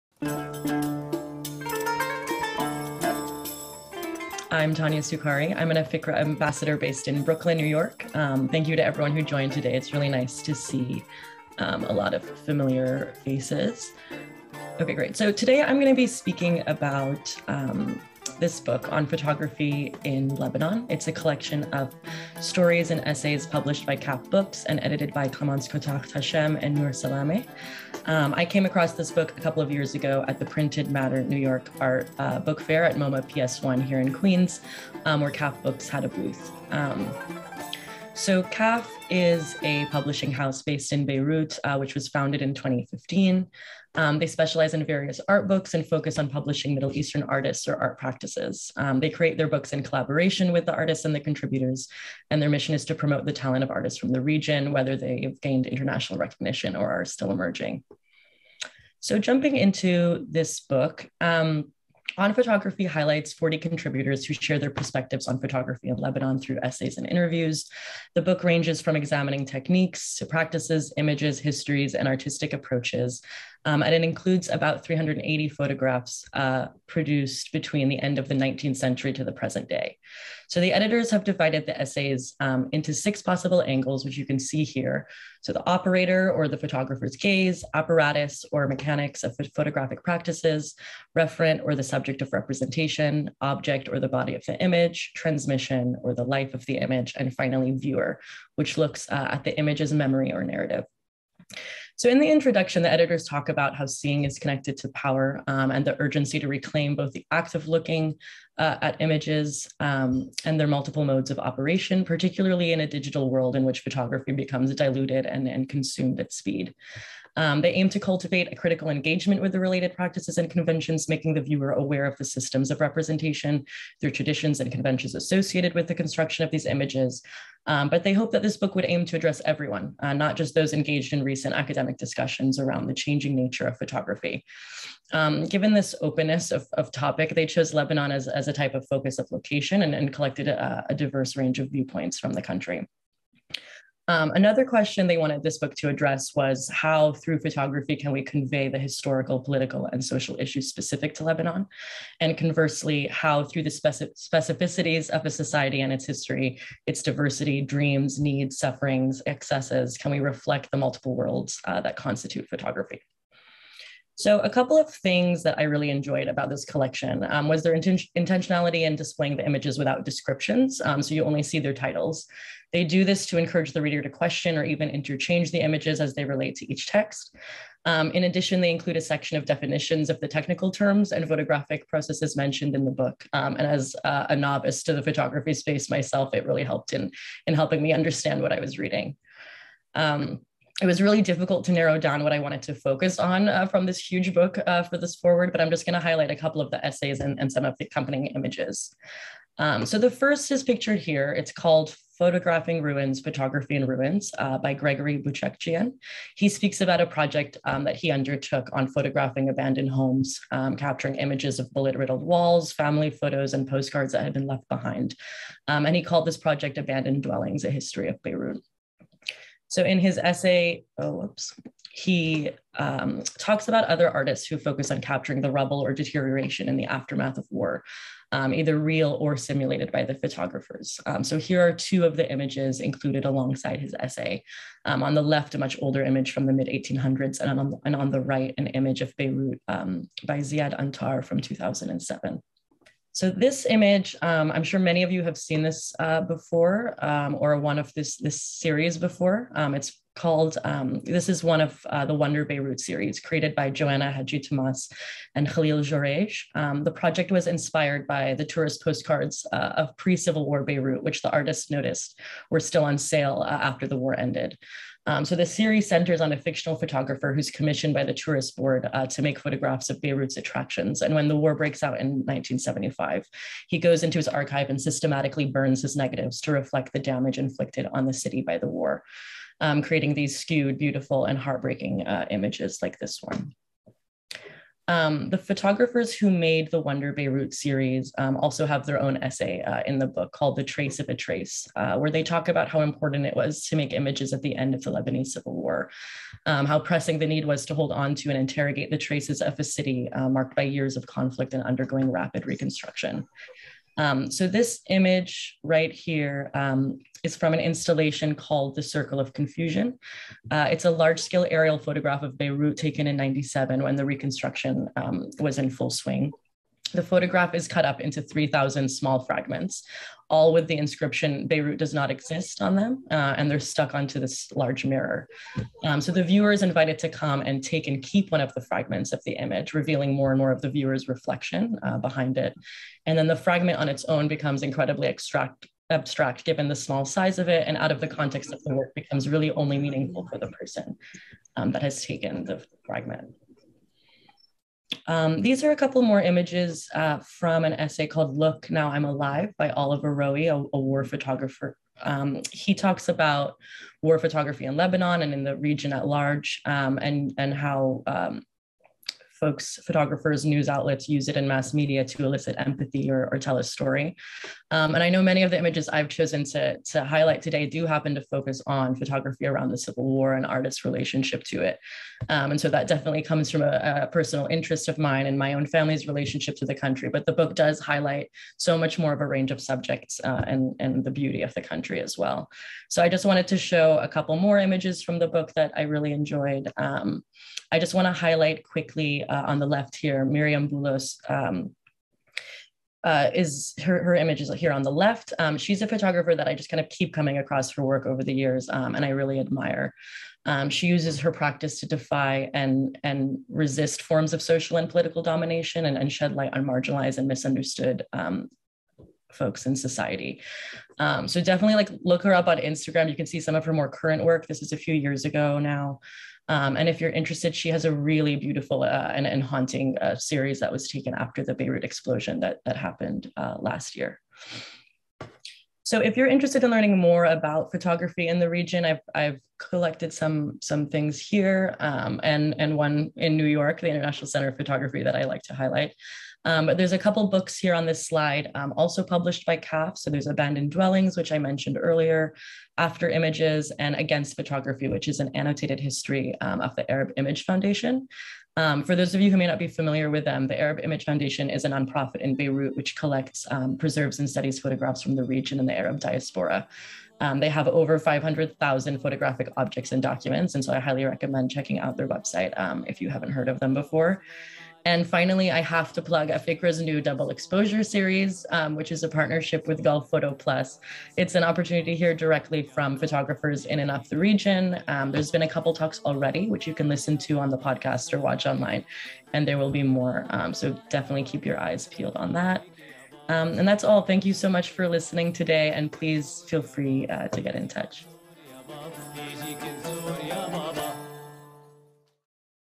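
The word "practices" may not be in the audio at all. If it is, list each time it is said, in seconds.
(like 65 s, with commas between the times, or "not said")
47 s, 70 s, 90 s, 119 s, 401 s.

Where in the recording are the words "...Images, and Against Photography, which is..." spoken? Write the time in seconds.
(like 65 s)
443 s.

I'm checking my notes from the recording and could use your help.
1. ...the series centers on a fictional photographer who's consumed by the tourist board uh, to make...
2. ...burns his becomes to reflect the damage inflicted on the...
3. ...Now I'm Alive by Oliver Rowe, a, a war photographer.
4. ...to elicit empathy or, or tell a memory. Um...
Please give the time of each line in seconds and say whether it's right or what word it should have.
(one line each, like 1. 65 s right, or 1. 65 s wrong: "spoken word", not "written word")
1. 265 s wrong: "commissioned", not "consumed"
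2. 275 s wrong: "negatives", not "becomes"
3. 348 s right
4. 362 s wrong: "story", not "memory".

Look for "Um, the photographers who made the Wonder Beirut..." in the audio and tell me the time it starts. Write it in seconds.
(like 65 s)
284 s.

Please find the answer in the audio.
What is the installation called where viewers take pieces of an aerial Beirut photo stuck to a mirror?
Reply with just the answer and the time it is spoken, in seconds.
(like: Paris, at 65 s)
The Circle of Confusion, at 308 s.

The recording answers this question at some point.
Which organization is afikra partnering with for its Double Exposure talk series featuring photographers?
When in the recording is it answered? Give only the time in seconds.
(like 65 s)
469 s.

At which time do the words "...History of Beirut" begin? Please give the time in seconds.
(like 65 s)
217 s.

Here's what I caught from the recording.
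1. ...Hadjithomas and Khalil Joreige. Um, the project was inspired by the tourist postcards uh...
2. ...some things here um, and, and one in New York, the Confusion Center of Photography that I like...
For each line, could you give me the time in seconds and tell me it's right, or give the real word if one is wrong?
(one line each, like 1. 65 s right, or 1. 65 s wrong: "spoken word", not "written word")
1. 254 s right
2. 430 s wrong: "International", not "Confusion".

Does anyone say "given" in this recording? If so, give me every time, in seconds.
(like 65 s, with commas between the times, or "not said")
135 s, 336 s.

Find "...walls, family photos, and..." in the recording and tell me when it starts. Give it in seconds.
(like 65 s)
212 s.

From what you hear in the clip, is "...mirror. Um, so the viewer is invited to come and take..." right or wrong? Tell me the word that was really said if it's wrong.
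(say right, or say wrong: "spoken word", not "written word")
right.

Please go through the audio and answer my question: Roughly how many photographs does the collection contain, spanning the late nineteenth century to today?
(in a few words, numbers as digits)
380.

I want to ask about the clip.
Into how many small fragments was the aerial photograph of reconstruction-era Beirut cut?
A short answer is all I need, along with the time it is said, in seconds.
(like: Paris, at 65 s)
3,000, at 318 s.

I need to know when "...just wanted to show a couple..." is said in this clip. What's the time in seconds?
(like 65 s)
383 s.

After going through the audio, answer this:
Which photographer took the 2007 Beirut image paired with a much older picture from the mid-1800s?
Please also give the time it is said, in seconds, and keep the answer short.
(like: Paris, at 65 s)
Ziad Antar, at 240 s.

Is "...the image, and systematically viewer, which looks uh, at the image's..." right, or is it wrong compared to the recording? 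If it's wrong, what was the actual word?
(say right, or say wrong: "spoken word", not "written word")
wrong: "finally", not "systematically".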